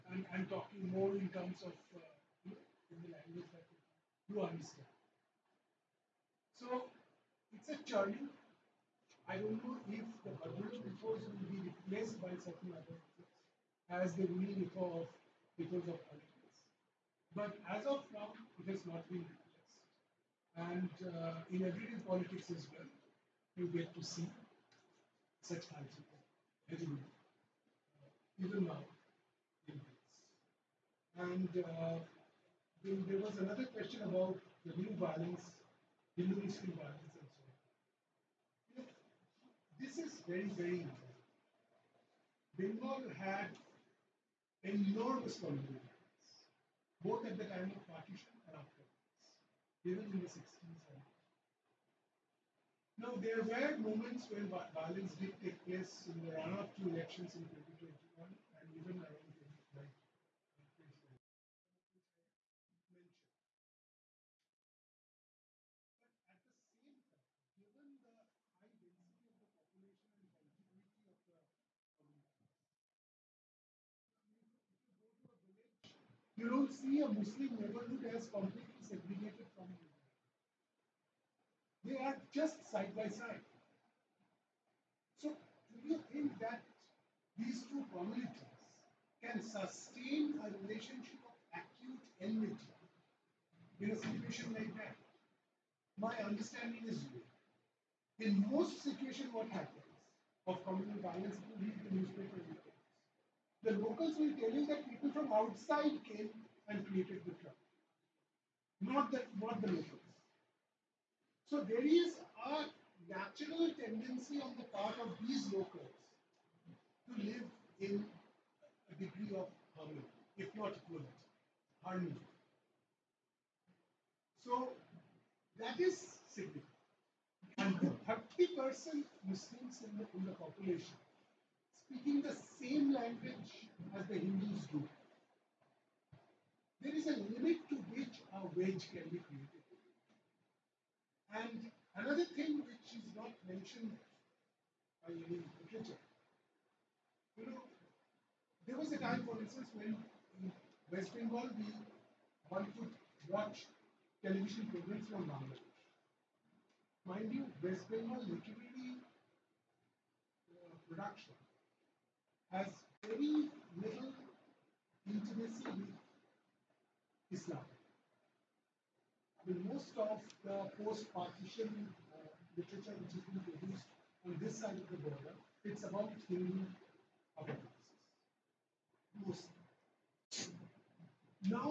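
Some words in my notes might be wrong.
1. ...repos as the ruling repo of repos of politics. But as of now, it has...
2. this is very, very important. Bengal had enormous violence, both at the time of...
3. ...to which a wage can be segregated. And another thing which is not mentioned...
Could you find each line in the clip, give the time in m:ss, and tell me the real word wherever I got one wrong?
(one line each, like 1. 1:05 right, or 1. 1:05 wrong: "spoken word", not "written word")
1. 0:12 right
2. 0:39 right
3. 2:17 wrong: "created", not "segregated".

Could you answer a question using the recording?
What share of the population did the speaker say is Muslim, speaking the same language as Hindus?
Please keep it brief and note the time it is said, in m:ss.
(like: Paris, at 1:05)
30%, at 2:08.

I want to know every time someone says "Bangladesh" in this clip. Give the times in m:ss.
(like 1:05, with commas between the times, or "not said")
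2:35.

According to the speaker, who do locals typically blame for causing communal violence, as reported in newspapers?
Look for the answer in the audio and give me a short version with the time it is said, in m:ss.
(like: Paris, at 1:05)
People from outside, at 1:44.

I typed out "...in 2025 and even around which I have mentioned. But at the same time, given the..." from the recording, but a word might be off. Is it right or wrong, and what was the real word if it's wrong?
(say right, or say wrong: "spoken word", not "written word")
wrong: "2021", not "2025".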